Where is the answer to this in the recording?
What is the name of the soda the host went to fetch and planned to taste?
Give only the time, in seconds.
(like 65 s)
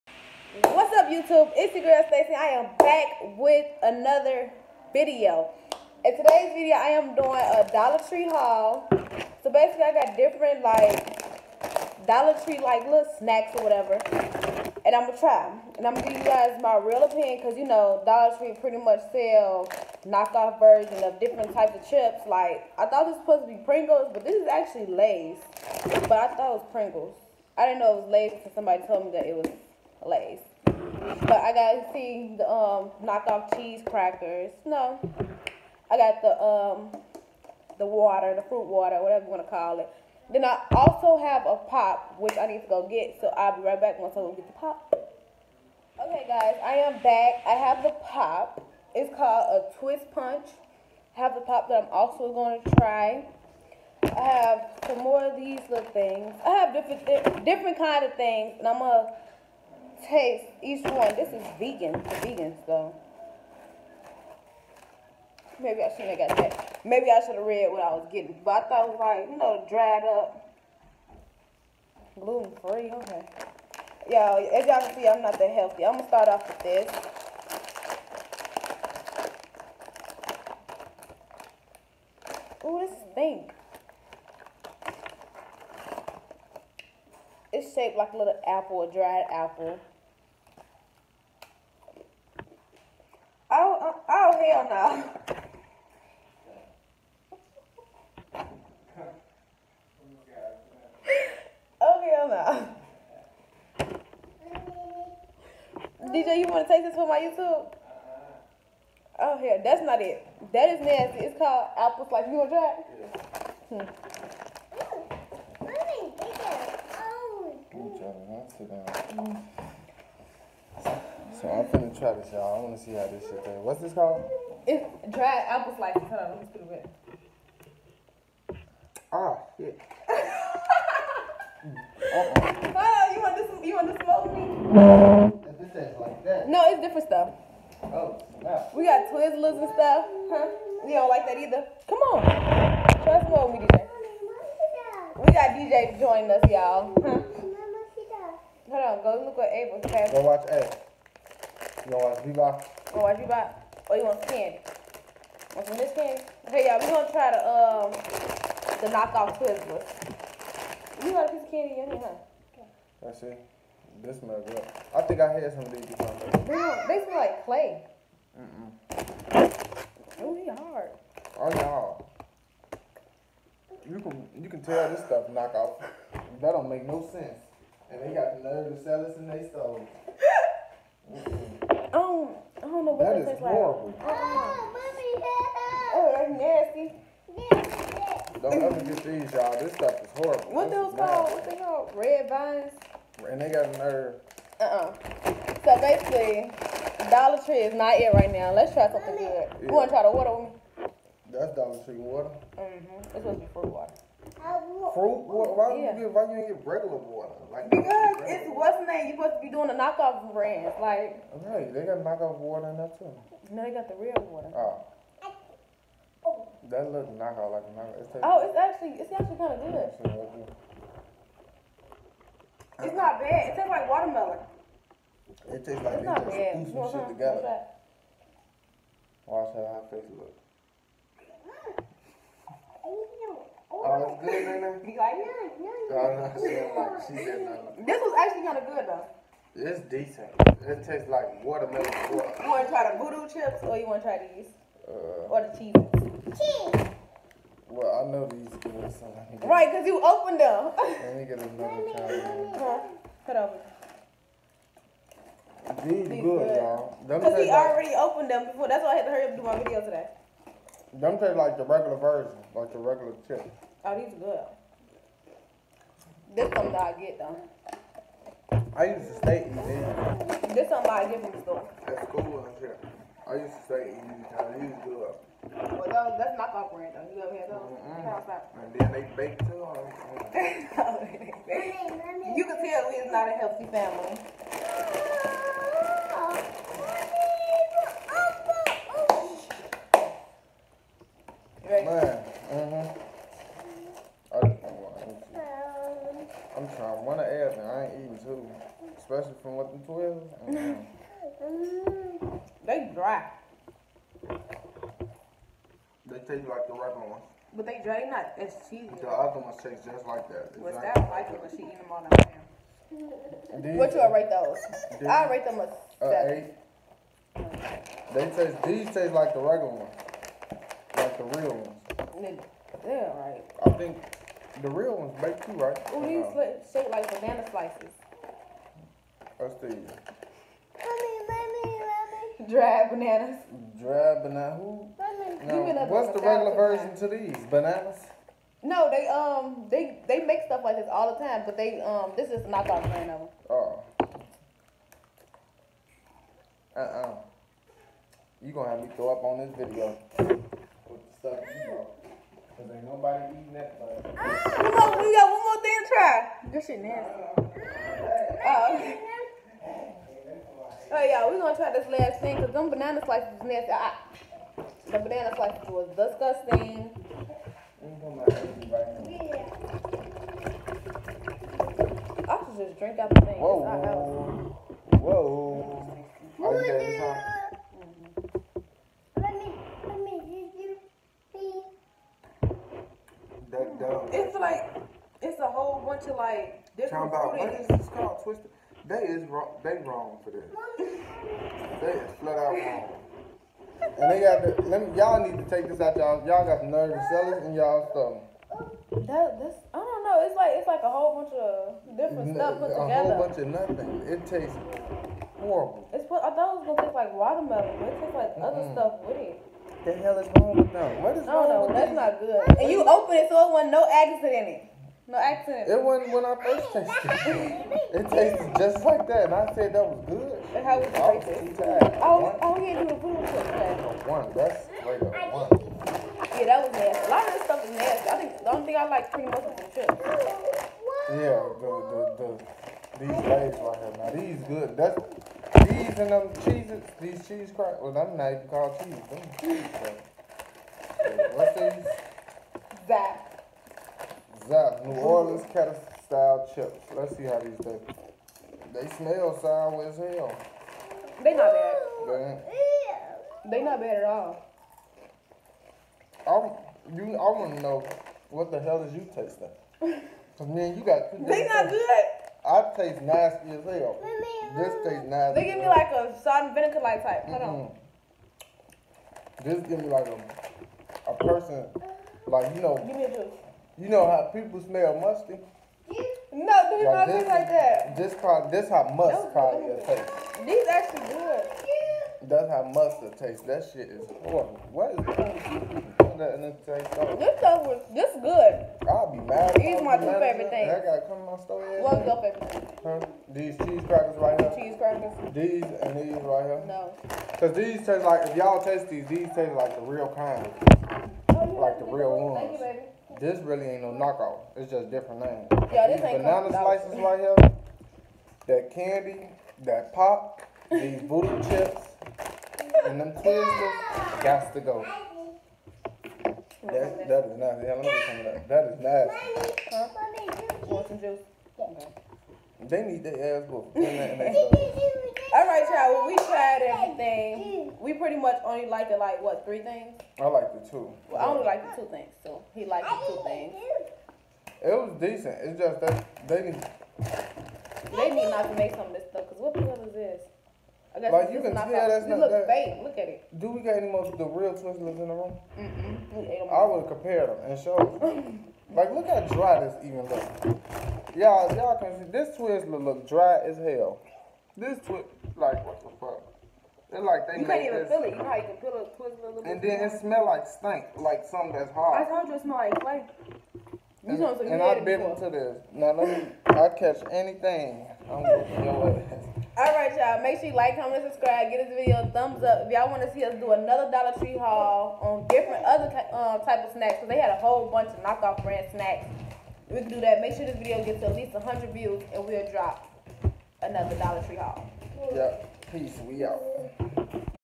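49 s.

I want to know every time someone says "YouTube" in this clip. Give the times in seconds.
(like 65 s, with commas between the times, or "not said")
1 s, 107 s.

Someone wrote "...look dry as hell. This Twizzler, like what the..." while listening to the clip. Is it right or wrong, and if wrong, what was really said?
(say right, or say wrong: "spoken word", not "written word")
right.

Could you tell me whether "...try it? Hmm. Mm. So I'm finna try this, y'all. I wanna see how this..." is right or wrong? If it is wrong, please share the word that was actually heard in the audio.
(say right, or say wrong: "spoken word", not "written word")
right.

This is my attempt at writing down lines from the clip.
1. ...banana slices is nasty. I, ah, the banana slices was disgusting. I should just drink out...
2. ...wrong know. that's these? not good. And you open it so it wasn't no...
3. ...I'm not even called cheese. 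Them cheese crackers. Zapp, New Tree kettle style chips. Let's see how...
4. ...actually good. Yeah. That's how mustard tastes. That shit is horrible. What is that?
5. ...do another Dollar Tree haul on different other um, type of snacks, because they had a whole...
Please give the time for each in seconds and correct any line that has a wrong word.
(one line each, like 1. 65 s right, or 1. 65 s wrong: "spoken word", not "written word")
1. 362 s right
2. 411 s right
3. 437 s wrong: "Orleans", not "Tree"
4. 480 s right
5. 573 s right.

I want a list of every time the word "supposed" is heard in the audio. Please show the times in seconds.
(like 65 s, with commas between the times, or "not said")
23 s, 203 s, 209 s.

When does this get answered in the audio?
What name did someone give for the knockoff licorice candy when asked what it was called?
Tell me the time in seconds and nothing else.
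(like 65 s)
191 s.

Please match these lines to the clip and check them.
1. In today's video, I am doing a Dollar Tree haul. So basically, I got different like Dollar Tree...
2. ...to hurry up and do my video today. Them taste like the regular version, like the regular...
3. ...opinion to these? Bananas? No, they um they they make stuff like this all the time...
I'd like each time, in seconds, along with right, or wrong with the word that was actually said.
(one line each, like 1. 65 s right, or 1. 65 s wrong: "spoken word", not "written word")
1. 6 s right
2. 259 s right
3. 336 s wrong: "version", not "opinion".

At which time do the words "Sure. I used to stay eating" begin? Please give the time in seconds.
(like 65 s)
272 s.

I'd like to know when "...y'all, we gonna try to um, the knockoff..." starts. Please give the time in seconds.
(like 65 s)
156 s.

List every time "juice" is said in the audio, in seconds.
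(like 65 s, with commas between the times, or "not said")
473 s, 520 s.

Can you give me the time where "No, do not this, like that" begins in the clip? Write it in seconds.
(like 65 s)
476 s.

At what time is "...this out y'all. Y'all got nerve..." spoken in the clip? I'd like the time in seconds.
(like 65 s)
395 s.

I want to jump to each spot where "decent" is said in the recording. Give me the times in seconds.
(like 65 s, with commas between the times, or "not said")
239 s, 534 s.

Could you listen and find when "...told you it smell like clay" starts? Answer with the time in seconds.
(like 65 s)
562 s.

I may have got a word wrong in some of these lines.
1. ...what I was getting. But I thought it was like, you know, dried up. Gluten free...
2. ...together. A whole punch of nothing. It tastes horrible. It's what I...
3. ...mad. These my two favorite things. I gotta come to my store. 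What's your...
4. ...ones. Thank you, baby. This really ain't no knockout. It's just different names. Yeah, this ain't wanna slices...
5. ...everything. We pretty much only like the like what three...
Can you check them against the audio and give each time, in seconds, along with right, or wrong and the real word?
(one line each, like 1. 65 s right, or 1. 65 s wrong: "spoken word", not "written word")
1. 67 s right
2. 402 s wrong: "bunch", not "punch"
3. 489 s right
4. 502 s wrong: "banana", not "wanna"
5. 526 s right.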